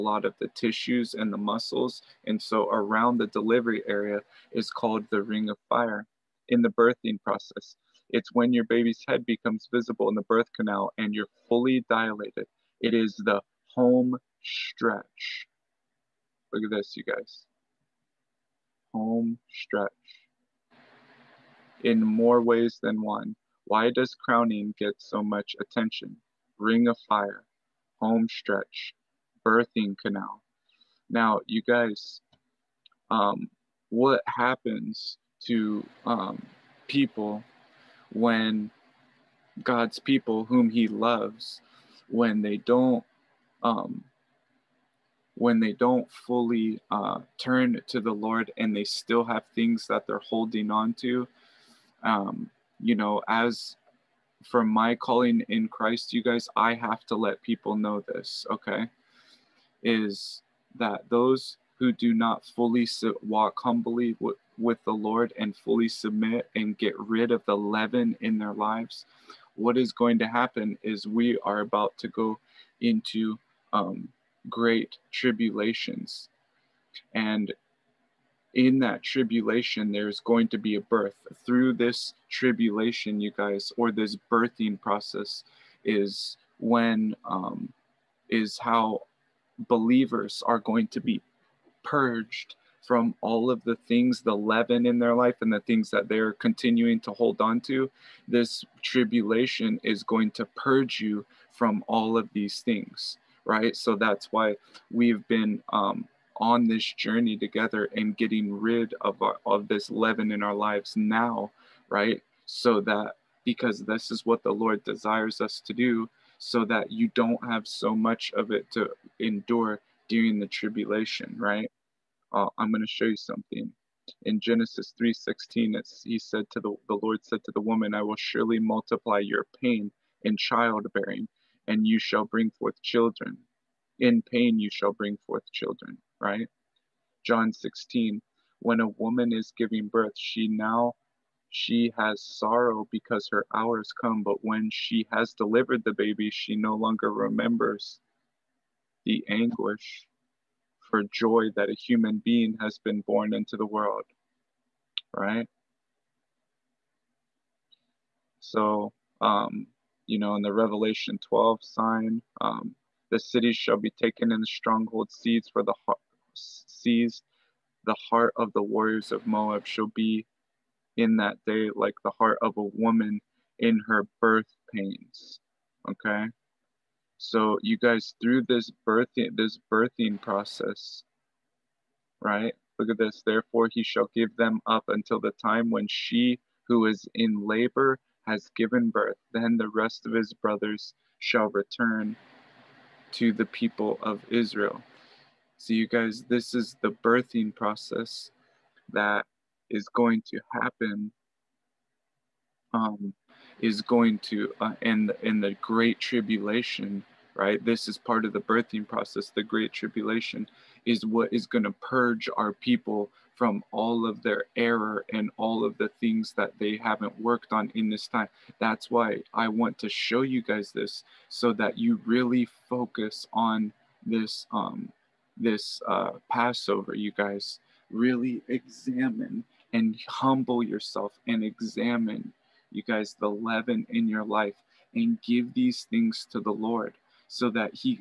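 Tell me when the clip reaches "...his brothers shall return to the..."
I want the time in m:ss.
3:10.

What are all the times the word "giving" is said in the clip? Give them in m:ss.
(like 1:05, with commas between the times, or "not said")
2:19.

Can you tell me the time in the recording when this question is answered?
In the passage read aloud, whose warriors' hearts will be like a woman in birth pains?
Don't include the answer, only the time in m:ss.
2:49.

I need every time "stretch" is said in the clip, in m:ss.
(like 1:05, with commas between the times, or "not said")
0:14, 0:19, 0:28.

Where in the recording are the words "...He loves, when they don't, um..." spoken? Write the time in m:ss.
0:40.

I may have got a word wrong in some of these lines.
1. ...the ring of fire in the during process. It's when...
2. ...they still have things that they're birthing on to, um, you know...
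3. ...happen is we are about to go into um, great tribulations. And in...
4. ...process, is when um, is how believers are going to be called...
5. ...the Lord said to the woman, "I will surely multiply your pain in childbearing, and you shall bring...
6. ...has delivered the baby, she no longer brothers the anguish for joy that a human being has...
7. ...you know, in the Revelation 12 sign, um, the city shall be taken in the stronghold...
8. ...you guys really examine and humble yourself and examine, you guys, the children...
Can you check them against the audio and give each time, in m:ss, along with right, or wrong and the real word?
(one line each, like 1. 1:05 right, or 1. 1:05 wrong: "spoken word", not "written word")
1. 0:05 wrong: "birthing", not "during"
2. 0:48 wrong: "holding", not "birthing"
3. 1:10 right
4. 1:24 wrong: "purged", not "called"
5. 2:06 right
6. 2:25 wrong: "remembers", not "brothers"
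7. 2:40 right
8. 3:46 wrong: "leaven", not "children".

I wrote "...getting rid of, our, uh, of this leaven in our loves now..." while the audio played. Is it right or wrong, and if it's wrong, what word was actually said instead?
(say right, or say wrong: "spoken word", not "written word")
wrong: "lives", not "loves".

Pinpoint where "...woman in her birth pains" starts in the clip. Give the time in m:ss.
2:52.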